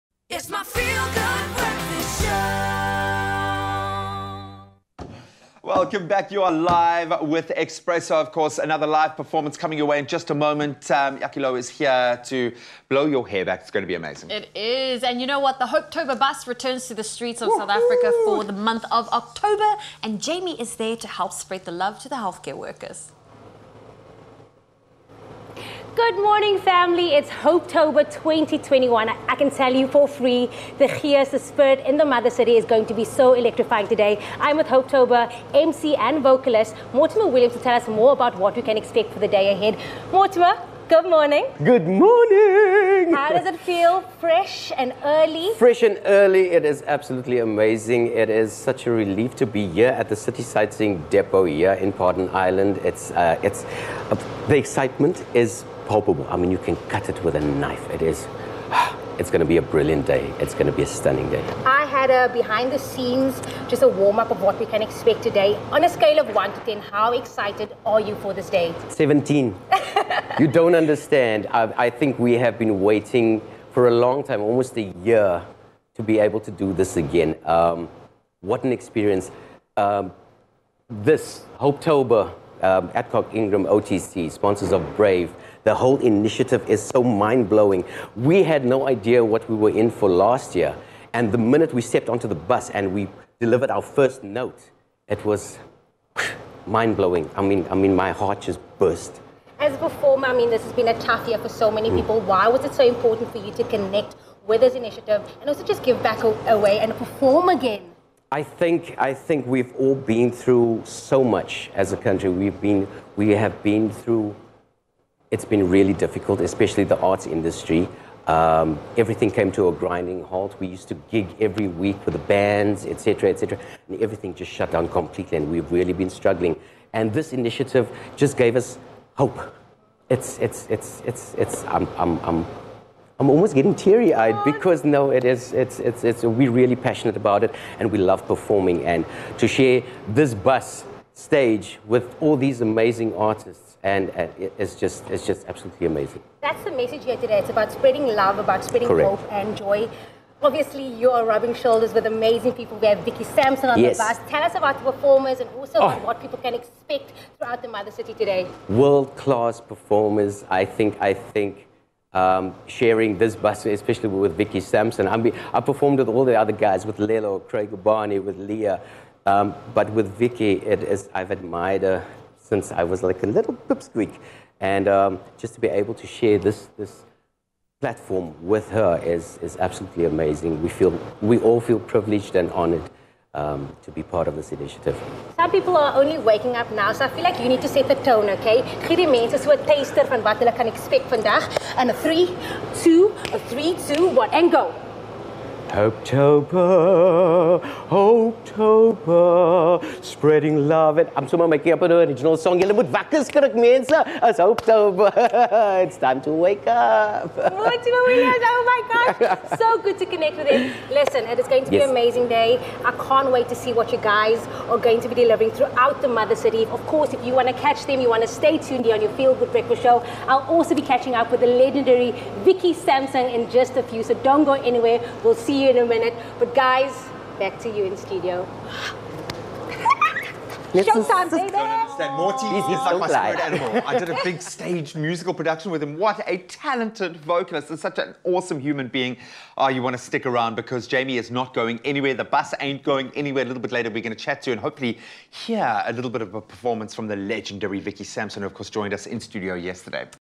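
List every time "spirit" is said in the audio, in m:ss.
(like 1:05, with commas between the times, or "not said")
0:31, 3:53.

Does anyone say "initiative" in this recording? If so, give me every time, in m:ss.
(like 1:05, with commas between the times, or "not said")
1:25, 1:44, 2:07, 3:04.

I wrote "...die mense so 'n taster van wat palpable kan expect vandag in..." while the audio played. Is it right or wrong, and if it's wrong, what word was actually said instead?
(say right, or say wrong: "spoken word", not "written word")
wrong: "hulle", not "palpable".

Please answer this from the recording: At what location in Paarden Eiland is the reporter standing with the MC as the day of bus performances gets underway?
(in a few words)
City Sightseeing Depot.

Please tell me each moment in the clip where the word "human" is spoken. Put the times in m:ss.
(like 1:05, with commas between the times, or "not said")
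3:58.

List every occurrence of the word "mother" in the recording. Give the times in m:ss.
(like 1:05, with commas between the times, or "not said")
0:32, 2:37, 3:36.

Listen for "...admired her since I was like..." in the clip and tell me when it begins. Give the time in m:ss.
2:51.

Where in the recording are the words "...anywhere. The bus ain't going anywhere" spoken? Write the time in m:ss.
4:01.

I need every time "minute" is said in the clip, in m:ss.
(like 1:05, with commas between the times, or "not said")
1:31, 3:45.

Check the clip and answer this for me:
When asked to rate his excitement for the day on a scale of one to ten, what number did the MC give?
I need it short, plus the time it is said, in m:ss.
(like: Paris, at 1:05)
17, at 1:08.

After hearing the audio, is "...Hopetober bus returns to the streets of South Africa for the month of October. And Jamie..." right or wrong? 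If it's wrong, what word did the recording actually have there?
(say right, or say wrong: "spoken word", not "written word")
right.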